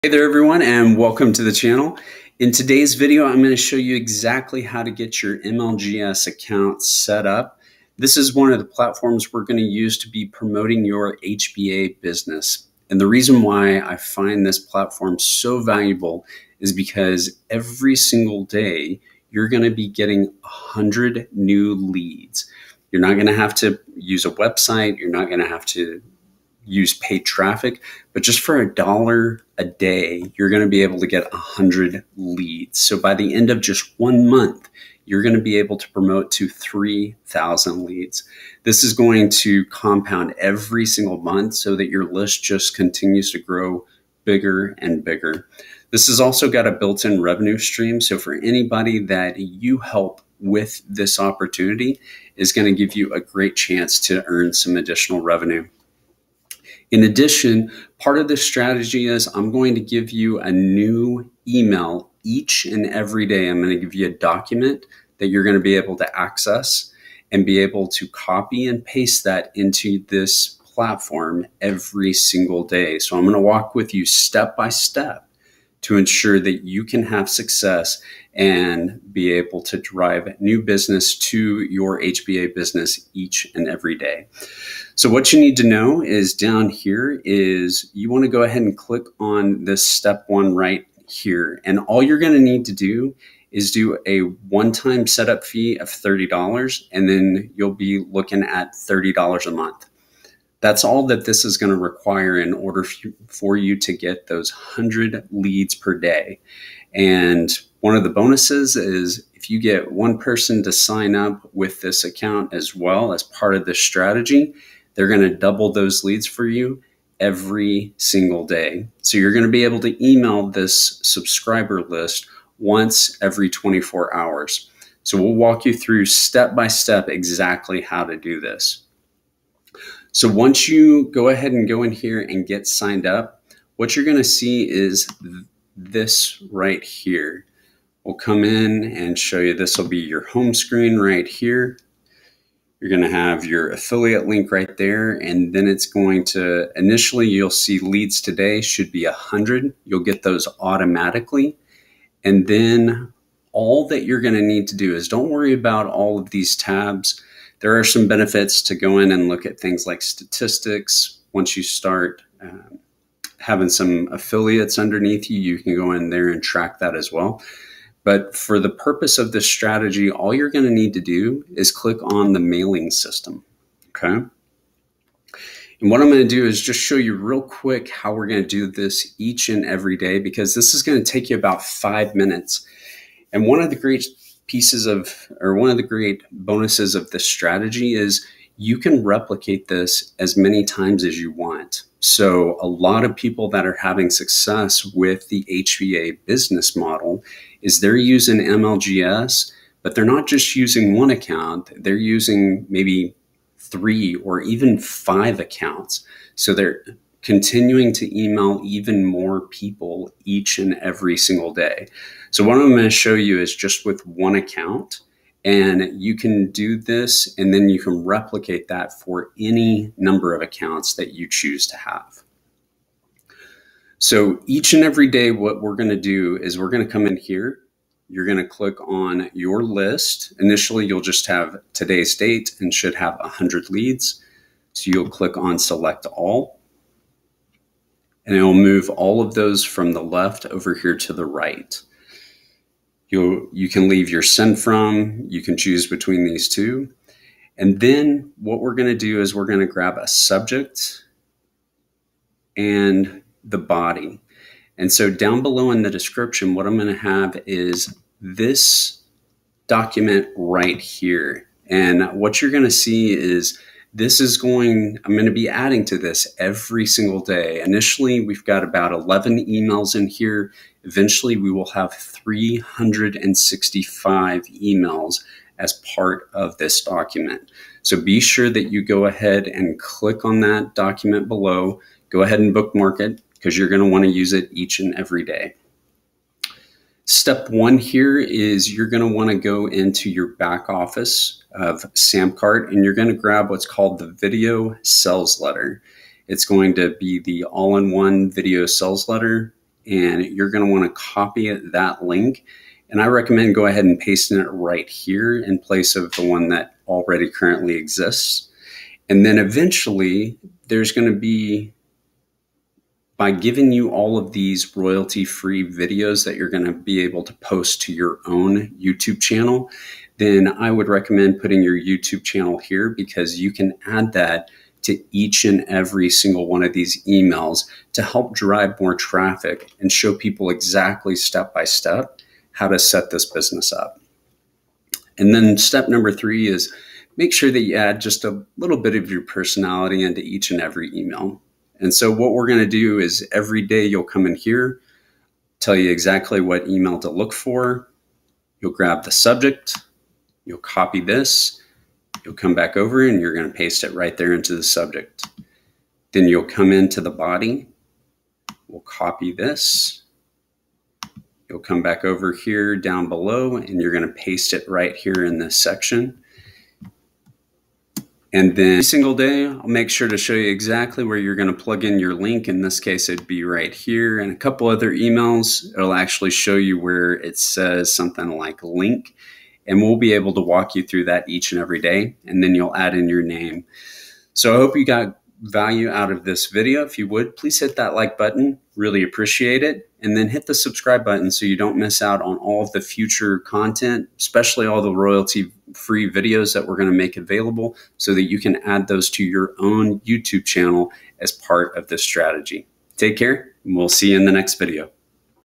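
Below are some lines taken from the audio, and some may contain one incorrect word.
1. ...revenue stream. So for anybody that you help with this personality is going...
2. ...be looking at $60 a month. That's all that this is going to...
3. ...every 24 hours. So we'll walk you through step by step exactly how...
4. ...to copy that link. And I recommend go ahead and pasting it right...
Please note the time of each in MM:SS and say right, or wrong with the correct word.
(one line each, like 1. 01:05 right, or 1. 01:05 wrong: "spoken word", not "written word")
1. 00:47 wrong: "opportunity", not "personality"
2. 01:37 wrong: "30", not "60"
3. 02:03 right
4. 05:00 right.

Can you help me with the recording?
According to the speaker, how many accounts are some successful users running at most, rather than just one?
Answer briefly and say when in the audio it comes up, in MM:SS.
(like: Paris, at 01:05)
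5, at 03:24.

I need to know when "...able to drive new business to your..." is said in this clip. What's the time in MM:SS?
01:19.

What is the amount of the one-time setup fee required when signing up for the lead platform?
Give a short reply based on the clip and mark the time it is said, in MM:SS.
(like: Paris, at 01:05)
$30, at 01:34.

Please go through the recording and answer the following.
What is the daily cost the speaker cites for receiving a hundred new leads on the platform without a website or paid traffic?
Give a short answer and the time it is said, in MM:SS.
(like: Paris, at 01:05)
a dollar a day, at 00:28.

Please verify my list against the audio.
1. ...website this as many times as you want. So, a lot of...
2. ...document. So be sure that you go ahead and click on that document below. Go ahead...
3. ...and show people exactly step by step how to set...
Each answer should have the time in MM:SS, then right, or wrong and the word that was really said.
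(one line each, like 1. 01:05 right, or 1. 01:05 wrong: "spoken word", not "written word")
1. 03:09 wrong: "replicate", not "website"
2. 04:36 right
3. 05:29 right.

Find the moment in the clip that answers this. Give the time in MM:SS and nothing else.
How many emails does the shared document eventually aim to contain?
04:31.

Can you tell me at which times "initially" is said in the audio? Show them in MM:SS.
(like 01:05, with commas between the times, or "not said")
02:26, 03:50, 04:27.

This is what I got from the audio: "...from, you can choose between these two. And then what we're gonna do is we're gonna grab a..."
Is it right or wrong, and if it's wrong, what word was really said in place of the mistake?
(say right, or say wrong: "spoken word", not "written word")
right.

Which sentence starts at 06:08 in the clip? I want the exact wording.
And then every single day, I'll make sure to show you exactly where you're going to plug in your link.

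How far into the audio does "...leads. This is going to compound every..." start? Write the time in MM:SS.
00:37.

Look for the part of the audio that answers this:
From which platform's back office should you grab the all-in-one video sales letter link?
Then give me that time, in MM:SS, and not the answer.
04:51.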